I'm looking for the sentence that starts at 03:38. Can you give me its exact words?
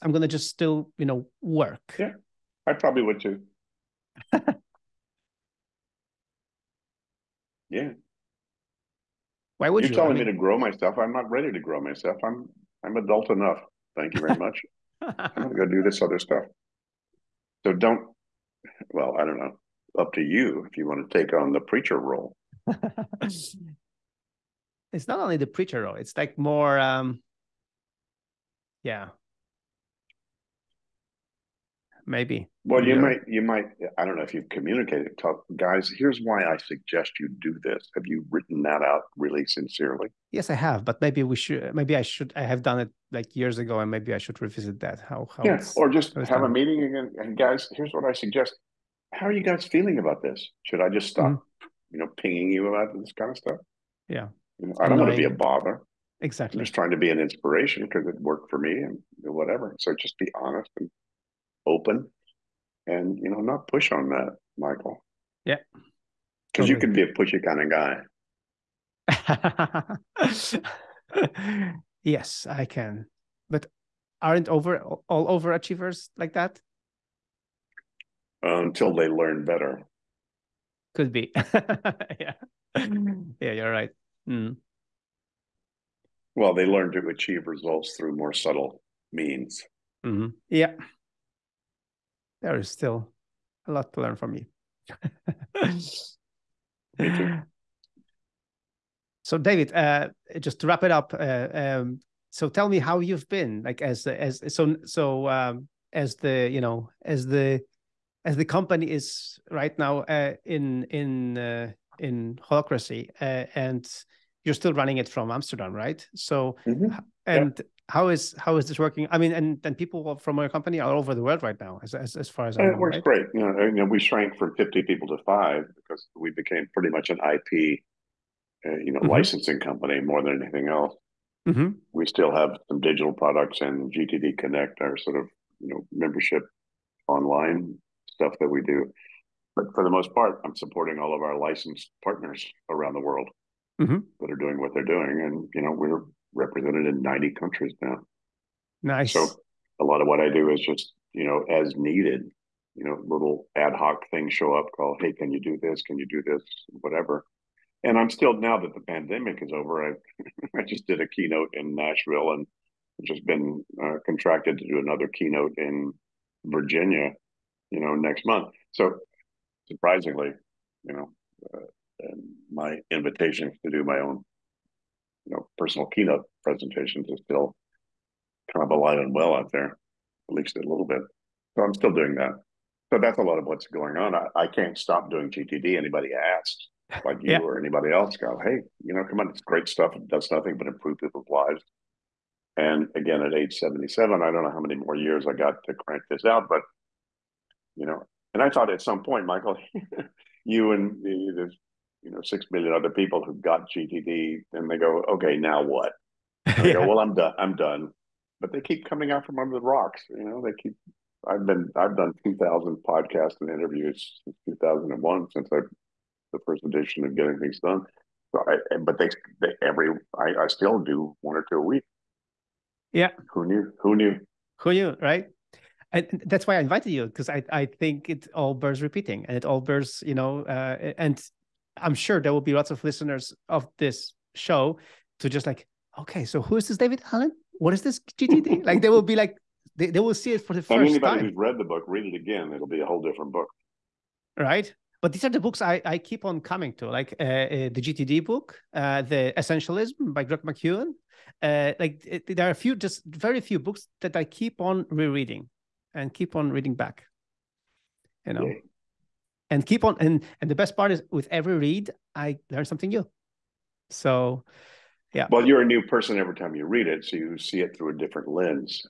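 So I, but they, they every I, I still do one or two a week.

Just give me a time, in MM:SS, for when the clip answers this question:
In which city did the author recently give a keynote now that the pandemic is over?
02:41.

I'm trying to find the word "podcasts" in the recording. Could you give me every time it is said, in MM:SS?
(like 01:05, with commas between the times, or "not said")
03:32.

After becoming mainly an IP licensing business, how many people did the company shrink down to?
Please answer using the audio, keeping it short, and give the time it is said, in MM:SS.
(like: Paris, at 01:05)
5, at 02:05.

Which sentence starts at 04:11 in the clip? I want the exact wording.
Uh, like it, there are a few, just very few books that I keep on rereading and keep on reading back.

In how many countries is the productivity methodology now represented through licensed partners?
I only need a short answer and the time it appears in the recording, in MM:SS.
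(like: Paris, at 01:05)
90, at 02:27.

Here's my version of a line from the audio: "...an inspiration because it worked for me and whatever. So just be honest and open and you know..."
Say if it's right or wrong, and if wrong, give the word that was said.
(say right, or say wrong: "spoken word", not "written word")
right.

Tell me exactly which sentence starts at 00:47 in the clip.
And guys, here's what I suggest.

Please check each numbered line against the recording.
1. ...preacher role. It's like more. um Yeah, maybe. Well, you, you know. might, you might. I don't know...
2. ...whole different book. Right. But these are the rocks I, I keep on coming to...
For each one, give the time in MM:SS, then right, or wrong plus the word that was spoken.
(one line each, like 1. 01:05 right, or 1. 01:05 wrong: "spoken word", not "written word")
1. 00:25 right
2. 04:02 wrong: "books", not "rocks".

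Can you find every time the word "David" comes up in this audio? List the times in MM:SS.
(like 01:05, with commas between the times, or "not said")
01:39, 03:56.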